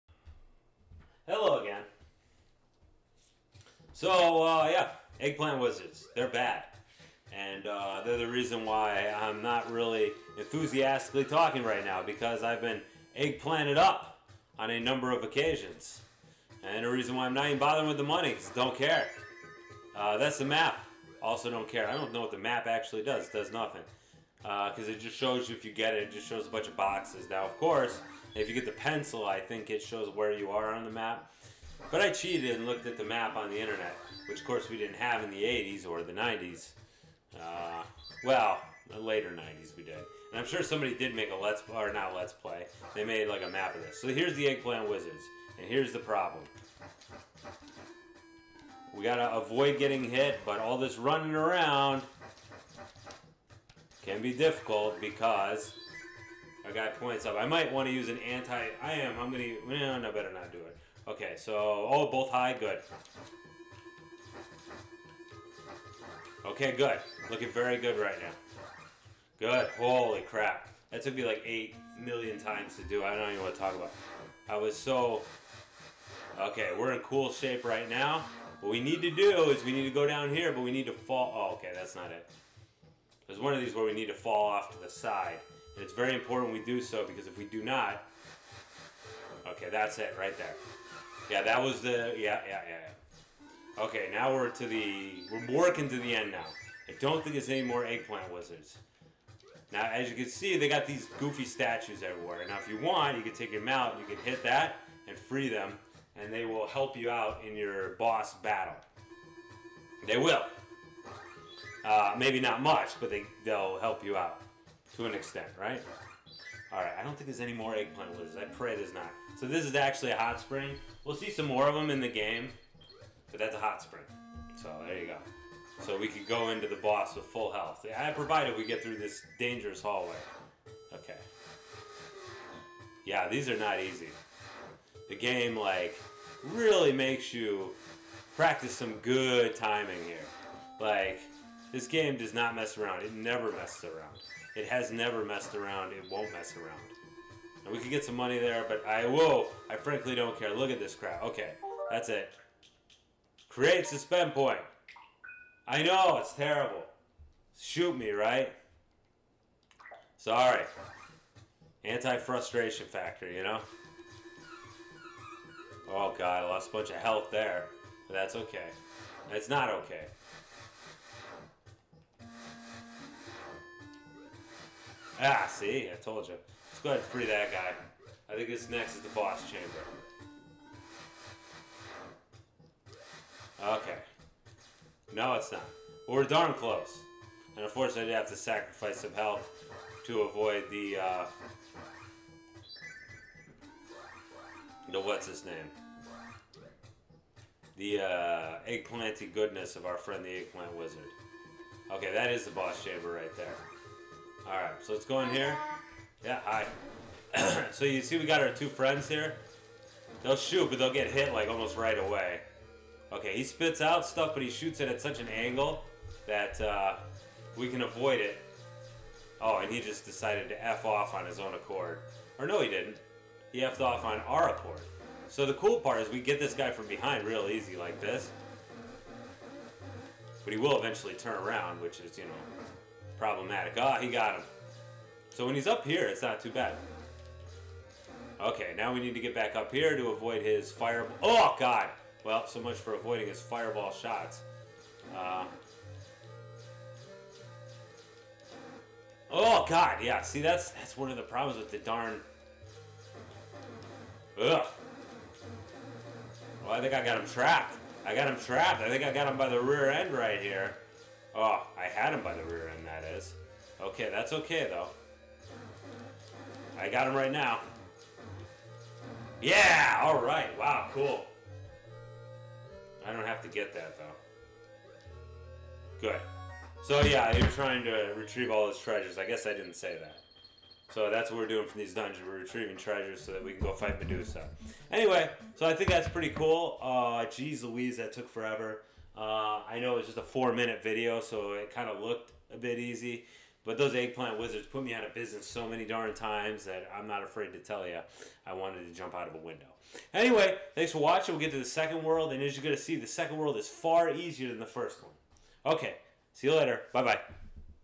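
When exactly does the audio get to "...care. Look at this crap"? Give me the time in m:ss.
2:30.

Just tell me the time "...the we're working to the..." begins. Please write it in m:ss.
1:34.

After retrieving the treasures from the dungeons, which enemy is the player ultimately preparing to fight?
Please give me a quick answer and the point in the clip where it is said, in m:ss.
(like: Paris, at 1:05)
Medusa, at 4:43.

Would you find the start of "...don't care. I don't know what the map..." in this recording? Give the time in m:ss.
0:21.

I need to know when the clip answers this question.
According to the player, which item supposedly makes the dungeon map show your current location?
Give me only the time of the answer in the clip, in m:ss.
0:28.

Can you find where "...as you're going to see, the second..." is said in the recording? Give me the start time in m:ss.
5:02.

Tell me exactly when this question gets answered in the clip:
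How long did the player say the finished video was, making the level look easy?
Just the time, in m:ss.
4:50.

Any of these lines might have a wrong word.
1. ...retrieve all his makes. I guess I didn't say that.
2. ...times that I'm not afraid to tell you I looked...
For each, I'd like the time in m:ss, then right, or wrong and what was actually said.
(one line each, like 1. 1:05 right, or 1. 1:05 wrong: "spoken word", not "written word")
1. 4:38 wrong: "treasures", not "makes"
2. 4:56 wrong: "wanted", not "looked".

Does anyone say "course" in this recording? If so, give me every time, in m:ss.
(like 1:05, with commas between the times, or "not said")
0:27, 0:34.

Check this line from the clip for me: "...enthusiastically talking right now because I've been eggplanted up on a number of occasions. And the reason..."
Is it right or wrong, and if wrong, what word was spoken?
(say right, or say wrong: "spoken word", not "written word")
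right.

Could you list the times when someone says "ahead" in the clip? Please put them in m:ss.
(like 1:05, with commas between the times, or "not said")
2:56.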